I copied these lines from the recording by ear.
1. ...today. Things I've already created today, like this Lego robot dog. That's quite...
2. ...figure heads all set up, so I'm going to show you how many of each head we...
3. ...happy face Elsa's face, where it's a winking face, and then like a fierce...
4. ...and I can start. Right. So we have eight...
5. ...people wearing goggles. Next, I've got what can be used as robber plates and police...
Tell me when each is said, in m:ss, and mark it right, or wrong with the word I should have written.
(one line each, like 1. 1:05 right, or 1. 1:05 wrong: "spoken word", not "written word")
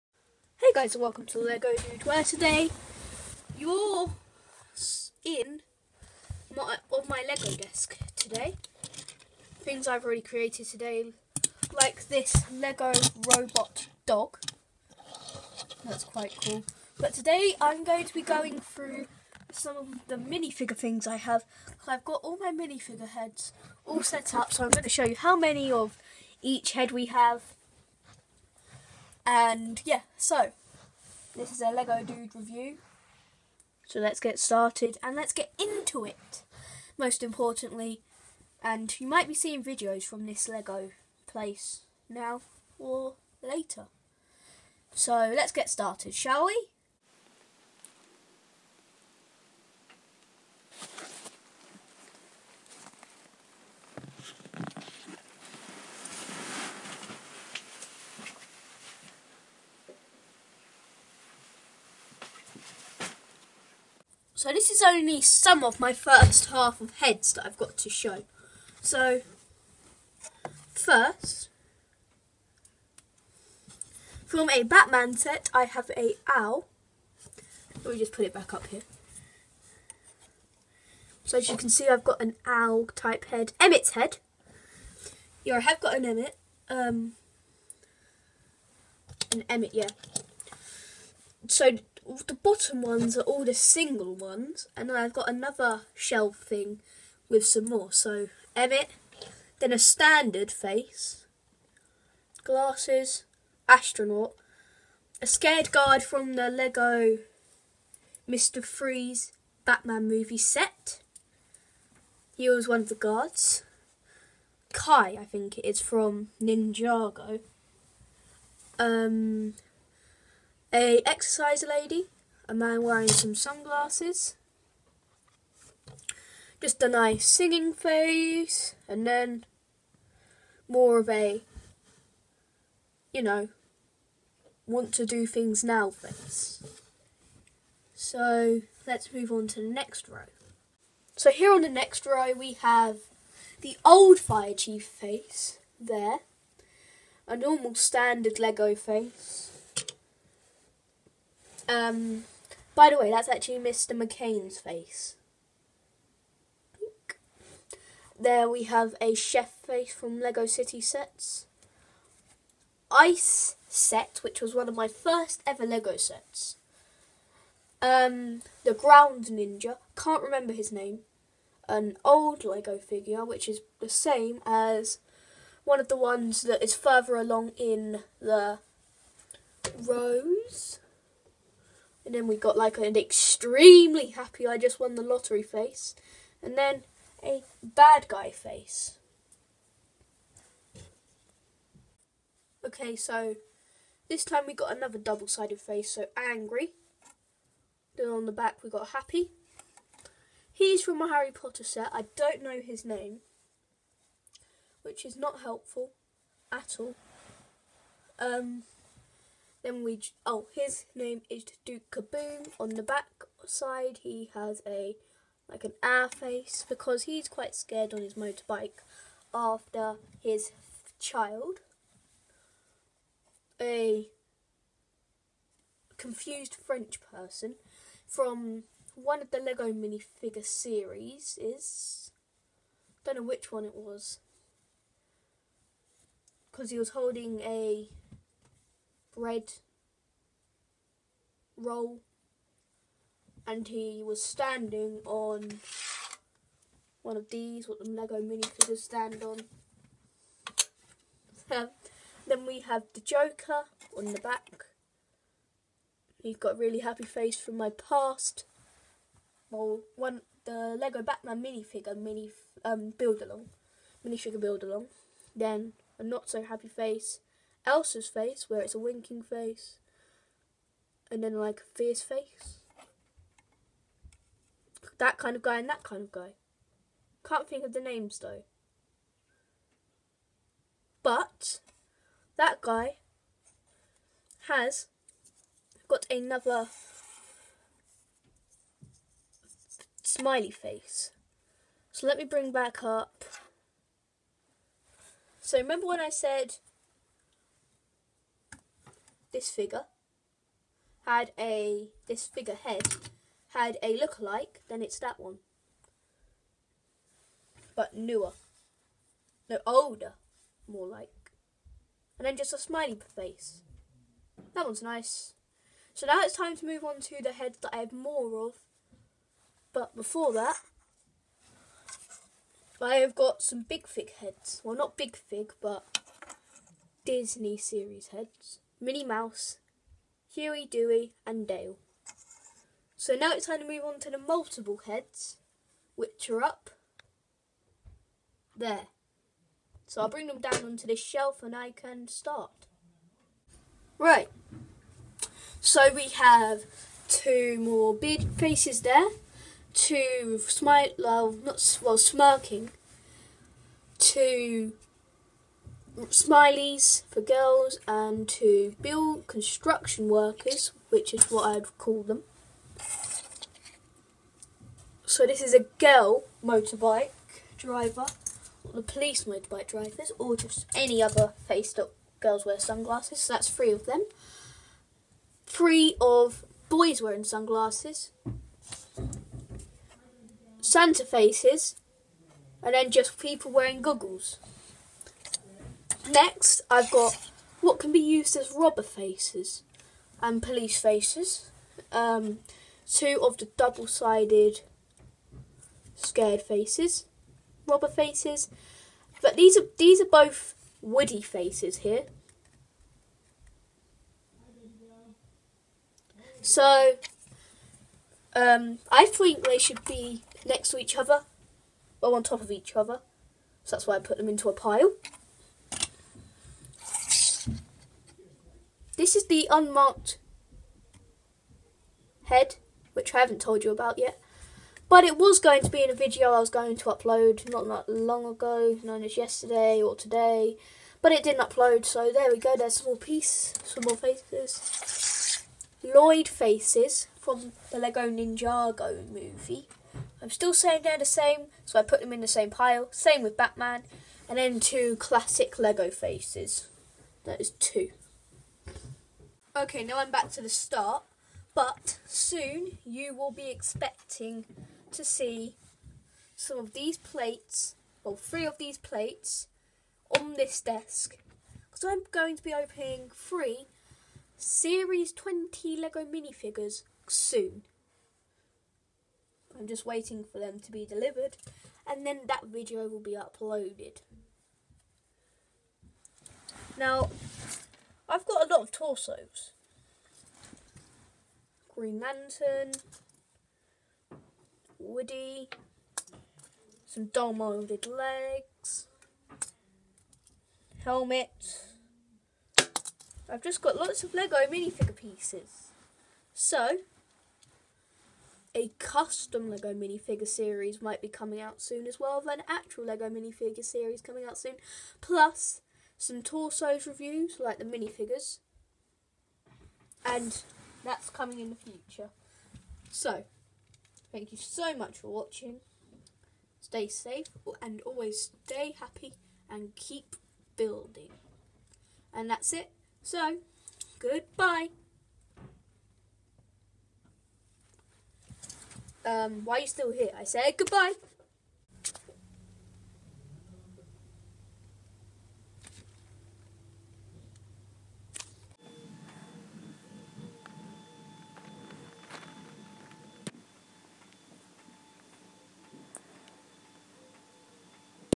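1. 0:08 right
2. 0:22 wrong: "minifigure", not "figure"
3. 4:26 right
4. 5:41 wrong: "two", not "eight"
5. 6:23 wrong: "faces", not "plates".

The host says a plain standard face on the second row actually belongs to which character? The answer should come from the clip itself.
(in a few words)
Mr. McCain.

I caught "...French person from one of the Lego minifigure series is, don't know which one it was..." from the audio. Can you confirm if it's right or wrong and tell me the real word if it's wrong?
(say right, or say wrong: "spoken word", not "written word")
right.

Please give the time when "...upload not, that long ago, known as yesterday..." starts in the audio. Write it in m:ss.
7:06.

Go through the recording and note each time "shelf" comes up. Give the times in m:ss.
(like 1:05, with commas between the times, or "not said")
1:35, 5:40.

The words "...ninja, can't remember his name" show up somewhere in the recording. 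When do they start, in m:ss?
2:49.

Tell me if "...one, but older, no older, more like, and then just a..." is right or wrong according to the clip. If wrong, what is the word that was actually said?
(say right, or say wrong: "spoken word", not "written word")
wrong: "newer", not "older".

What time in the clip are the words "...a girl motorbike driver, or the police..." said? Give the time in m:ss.
6:05.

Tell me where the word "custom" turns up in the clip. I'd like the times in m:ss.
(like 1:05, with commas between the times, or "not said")
8:18.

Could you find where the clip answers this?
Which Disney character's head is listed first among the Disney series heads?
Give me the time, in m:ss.
5:28.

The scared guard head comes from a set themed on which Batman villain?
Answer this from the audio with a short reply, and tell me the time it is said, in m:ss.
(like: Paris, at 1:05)
Mr. Freeze, at 1:48.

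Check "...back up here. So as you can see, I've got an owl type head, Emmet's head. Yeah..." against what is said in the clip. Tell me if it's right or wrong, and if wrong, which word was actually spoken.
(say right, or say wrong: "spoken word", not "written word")
right.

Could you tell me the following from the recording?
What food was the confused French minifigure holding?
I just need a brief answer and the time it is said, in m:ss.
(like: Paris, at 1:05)
Bread roll, at 3:59.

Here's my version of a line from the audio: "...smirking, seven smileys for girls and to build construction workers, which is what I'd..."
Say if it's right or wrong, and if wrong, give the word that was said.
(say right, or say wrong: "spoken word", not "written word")
wrong: "two", not "seven".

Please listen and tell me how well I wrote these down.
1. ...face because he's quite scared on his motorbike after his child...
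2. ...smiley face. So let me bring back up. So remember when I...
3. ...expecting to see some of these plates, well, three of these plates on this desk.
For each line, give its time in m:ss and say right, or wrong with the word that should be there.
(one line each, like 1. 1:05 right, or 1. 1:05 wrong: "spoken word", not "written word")
1. 3:36 right
2. 4:50 right
3. 7:33 right.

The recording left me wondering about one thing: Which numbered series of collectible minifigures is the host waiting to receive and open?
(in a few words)
Series 20.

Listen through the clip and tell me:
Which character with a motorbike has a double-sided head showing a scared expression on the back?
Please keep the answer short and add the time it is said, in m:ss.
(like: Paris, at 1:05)
Duke Caboom, at 3:31.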